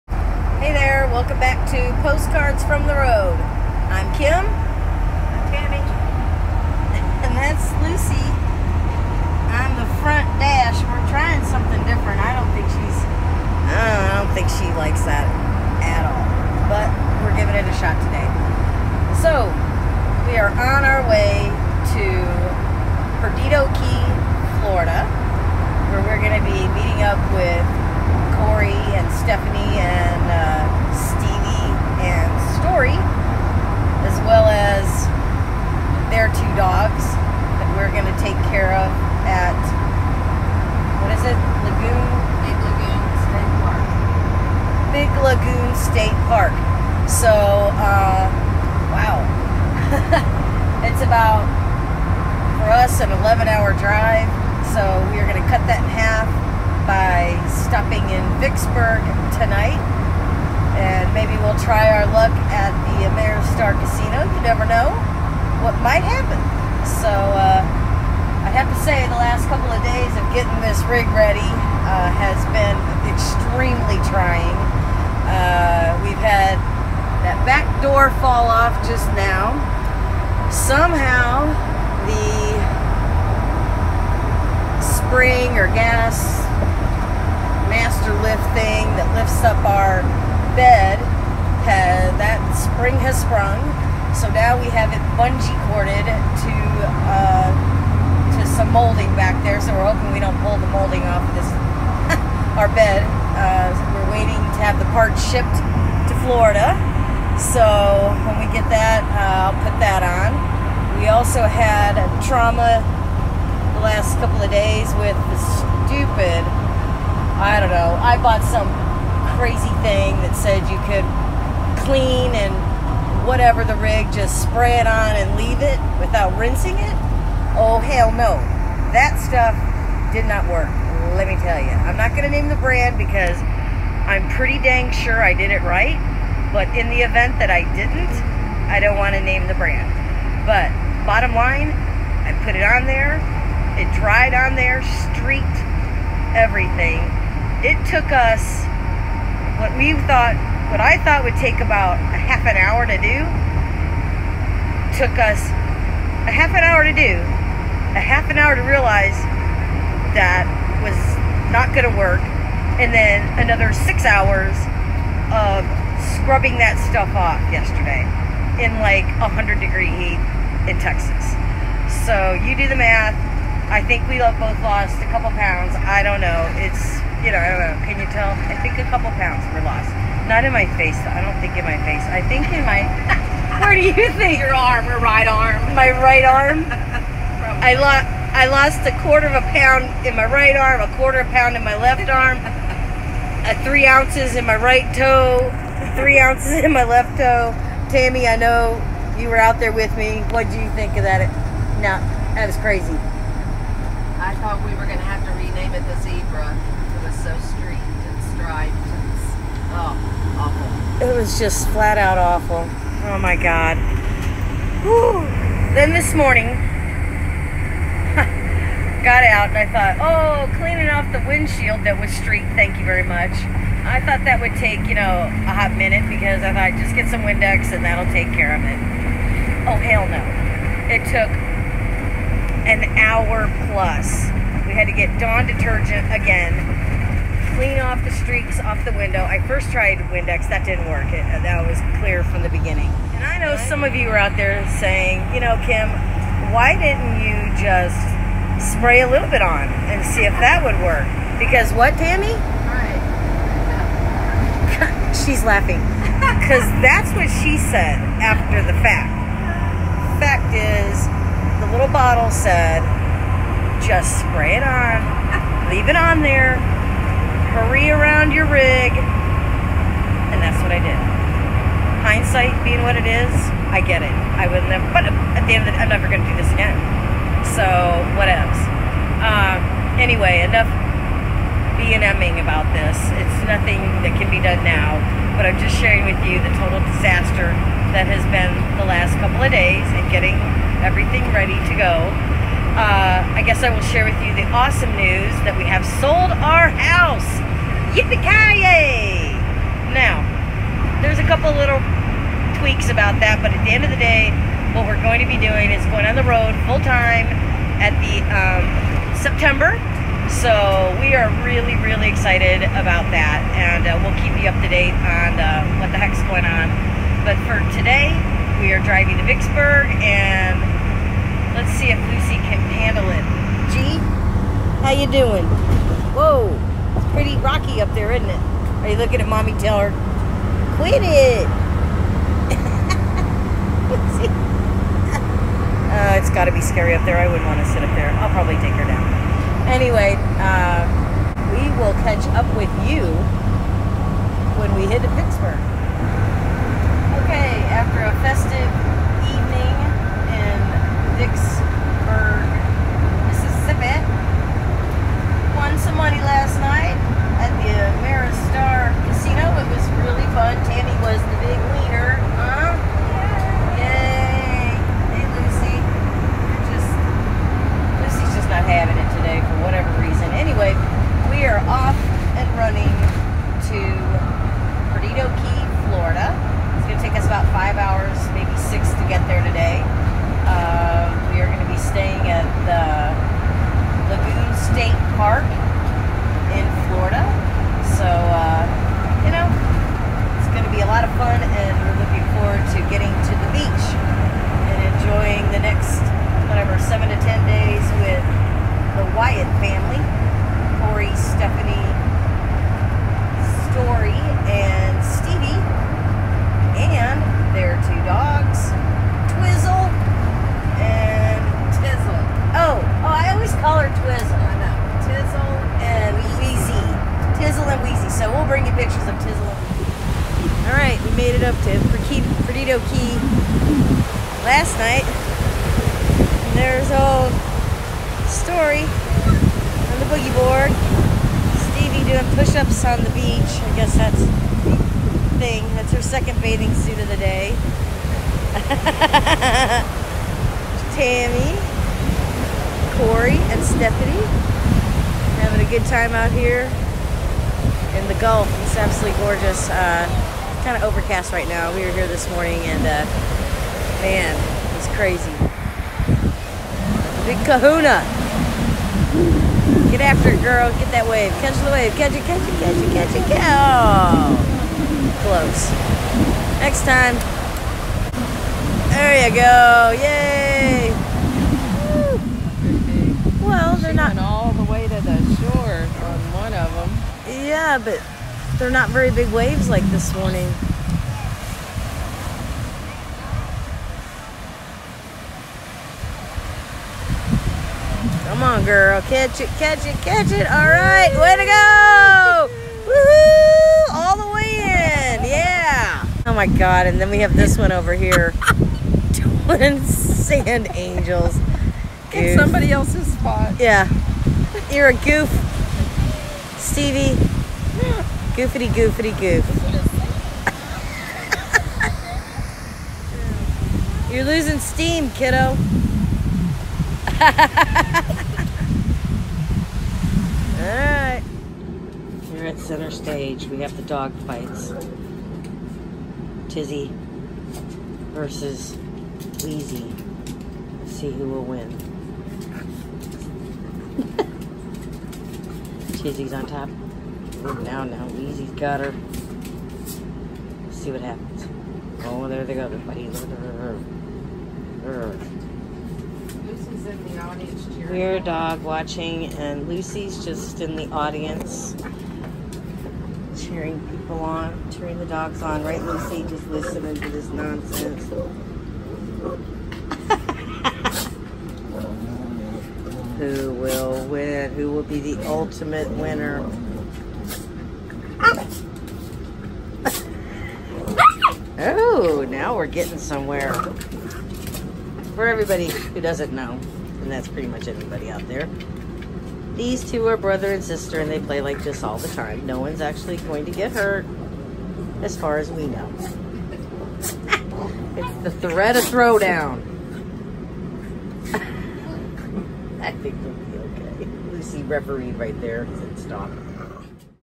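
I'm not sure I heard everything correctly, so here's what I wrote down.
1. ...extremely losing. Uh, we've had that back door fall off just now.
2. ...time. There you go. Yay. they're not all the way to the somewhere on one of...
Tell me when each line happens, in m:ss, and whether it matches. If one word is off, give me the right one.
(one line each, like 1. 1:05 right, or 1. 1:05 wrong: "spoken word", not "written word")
1. 1:13 wrong: "trying", not "losing"
2. 7:46 wrong: "shore", not "somewhere".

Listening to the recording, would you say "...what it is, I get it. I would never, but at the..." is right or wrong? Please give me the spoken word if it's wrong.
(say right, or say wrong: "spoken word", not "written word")
right.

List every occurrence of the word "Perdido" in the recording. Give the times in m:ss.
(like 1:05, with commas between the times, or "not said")
0:23, 7:02.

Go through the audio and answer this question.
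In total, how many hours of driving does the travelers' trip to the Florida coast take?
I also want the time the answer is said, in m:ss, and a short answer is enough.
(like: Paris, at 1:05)
11, at 0:53.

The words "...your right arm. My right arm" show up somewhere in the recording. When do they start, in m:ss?
3:04.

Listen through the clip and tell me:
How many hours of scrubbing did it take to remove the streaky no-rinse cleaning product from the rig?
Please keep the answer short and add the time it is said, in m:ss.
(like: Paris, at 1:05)
6, at 2:43.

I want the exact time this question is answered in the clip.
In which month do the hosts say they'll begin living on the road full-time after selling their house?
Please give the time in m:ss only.
5:09.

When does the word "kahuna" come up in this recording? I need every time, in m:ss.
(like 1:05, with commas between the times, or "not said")
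7:37.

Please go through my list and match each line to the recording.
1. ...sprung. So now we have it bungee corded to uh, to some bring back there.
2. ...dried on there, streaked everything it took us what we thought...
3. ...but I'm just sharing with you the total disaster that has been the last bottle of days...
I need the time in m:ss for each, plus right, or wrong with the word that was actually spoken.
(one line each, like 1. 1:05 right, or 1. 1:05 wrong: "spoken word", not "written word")
1. 1:33 wrong: "molding", not "bring"
2. 2:23 right
3. 4:45 wrong: "couple", not "bottle".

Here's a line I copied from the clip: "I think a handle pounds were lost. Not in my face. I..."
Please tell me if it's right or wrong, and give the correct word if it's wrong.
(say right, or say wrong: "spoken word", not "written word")
wrong: "couple", not "handle".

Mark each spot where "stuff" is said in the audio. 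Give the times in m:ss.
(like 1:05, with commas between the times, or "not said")
2:09, 2:46.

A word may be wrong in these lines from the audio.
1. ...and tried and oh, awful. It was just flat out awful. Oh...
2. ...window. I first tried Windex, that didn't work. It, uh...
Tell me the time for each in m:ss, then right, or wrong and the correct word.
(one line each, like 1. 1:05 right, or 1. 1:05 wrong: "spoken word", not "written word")
1. 3:27 wrong: "striped", not "tried"
2. 3:58 right.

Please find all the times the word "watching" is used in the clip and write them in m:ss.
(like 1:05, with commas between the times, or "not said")
9:08.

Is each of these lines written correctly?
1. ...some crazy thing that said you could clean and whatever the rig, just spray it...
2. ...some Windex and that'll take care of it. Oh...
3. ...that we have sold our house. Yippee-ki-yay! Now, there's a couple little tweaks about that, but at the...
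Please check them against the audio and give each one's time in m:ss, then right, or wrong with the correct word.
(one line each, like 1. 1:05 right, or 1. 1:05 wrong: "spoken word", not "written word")
1. 1:58 right
2. 3:47 right
3. 4:55 right.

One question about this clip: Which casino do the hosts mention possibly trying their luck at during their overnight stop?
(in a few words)
Ameristar Casino.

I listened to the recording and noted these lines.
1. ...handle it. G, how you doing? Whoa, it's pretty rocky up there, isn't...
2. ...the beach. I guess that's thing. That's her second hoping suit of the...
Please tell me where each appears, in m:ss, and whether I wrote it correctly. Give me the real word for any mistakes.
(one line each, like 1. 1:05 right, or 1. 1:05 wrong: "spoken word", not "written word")
1. 5:22 right
2. 7:13 wrong: "bathing", not "hoping".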